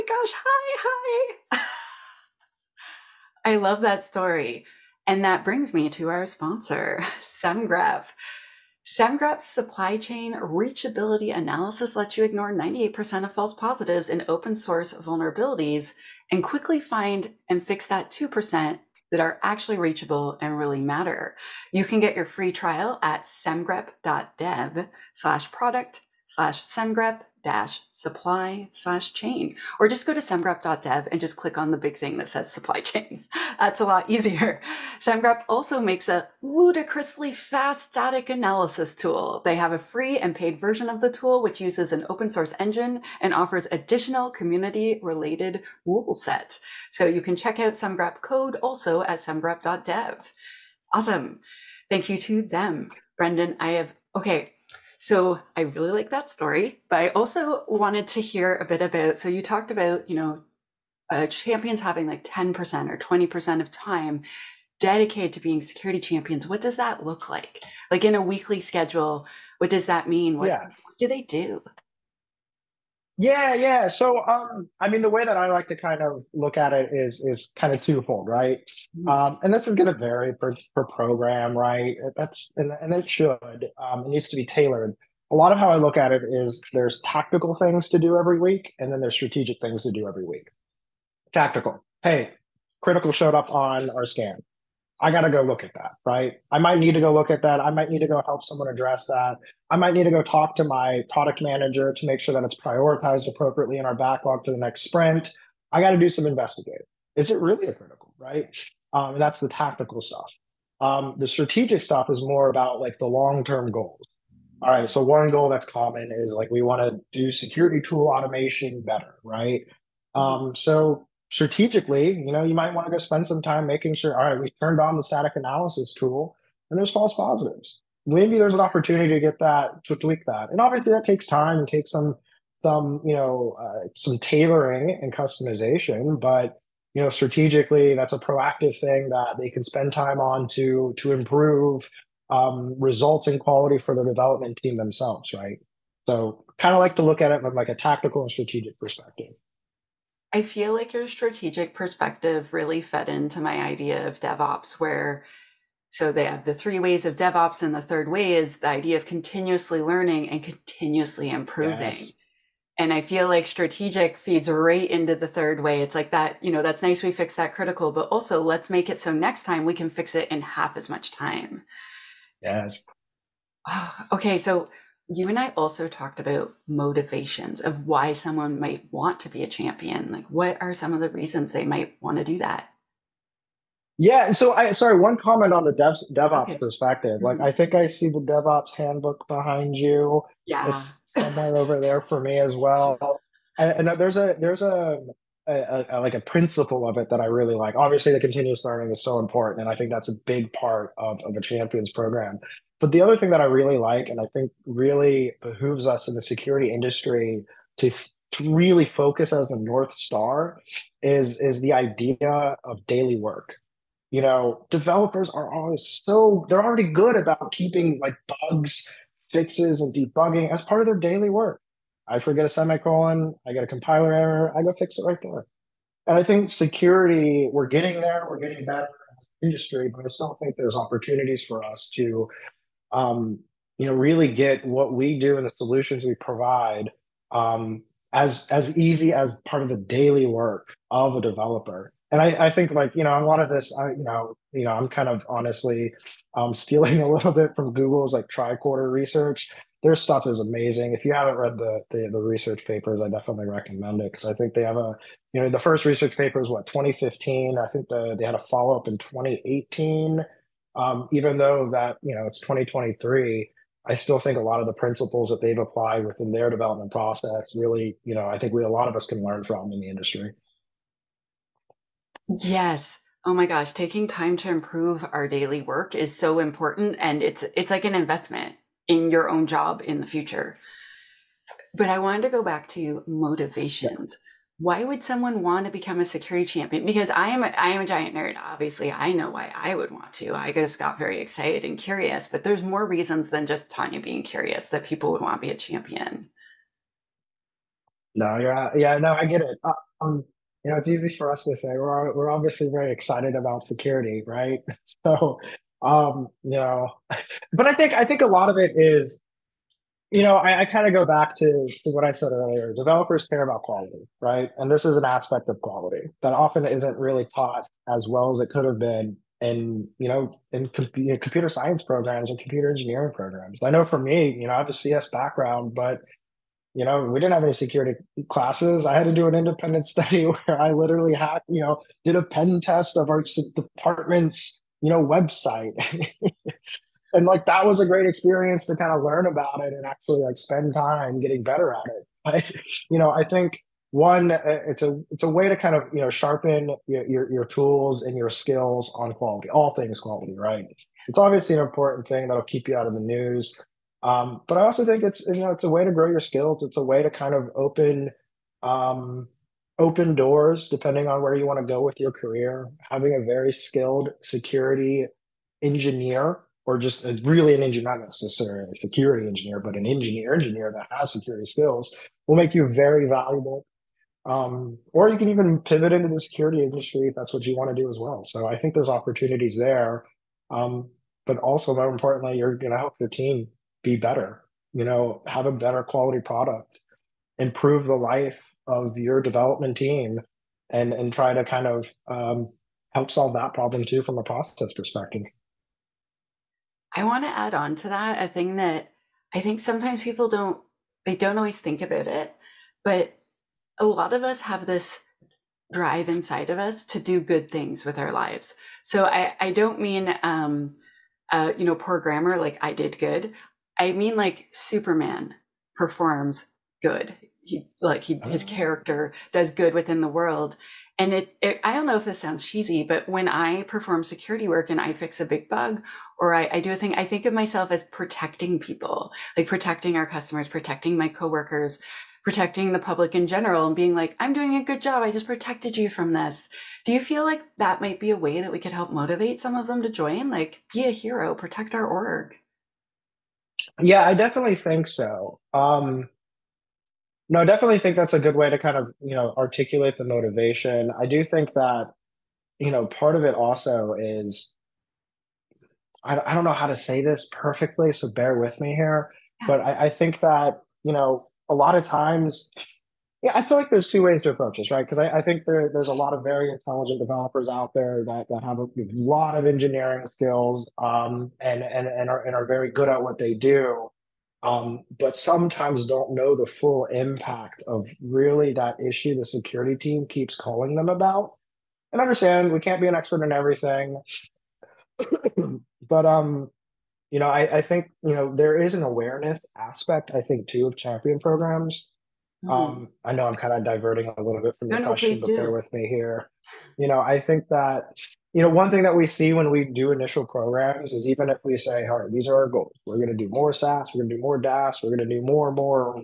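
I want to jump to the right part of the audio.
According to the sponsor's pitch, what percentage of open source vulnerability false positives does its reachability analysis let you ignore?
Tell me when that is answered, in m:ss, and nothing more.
0:12.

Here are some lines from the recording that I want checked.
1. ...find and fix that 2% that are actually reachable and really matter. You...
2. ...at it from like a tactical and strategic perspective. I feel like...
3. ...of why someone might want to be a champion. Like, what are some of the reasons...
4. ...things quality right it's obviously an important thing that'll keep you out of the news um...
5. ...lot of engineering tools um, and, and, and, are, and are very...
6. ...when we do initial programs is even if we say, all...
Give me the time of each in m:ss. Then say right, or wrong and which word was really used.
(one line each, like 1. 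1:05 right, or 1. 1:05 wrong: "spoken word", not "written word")
1. 0:16 right
2. 2:27 right
3. 2:57 right
4. 5:49 right
5. 7:48 wrong: "skills", not "tools"
6. 8:19 right.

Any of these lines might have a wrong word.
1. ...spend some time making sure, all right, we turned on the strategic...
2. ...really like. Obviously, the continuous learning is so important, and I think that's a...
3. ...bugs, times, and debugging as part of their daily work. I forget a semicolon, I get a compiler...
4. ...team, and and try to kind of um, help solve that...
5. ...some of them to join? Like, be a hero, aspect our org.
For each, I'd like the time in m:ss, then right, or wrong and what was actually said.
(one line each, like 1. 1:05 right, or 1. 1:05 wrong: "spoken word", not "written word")
1. 2:02 wrong: "static", not "strategic"
2. 3:17 right
3. 3:38 wrong: "fixes", not "times"
4. 6:29 right
5. 7:19 wrong: "protect", not "aspect".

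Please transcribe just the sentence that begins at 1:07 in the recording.
Like in a weekly schedule, what does that mean?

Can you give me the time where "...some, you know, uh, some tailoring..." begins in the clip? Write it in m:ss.
2:12.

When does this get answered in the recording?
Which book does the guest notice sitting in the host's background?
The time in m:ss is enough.
3:08.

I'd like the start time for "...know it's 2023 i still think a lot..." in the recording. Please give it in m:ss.
4:22.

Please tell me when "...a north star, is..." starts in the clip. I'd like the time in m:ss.
3:29.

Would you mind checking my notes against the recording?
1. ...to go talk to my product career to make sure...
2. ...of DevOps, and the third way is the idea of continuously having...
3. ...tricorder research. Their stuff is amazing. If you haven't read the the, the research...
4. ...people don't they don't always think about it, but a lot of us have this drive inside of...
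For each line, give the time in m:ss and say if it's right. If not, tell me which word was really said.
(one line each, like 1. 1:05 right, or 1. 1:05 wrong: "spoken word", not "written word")
1. 1:40 wrong: "manager", not "career"
2. 2:37 wrong: "learning", not "having"
3. 4:08 right
4. 6:40 right.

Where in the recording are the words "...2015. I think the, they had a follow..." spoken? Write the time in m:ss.
4:16.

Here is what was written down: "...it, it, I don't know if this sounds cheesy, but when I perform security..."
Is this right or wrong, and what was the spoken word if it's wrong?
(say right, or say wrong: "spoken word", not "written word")
right.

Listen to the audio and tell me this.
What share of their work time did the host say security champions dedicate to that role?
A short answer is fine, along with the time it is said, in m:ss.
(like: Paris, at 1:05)
10% or 20%, at 1:02.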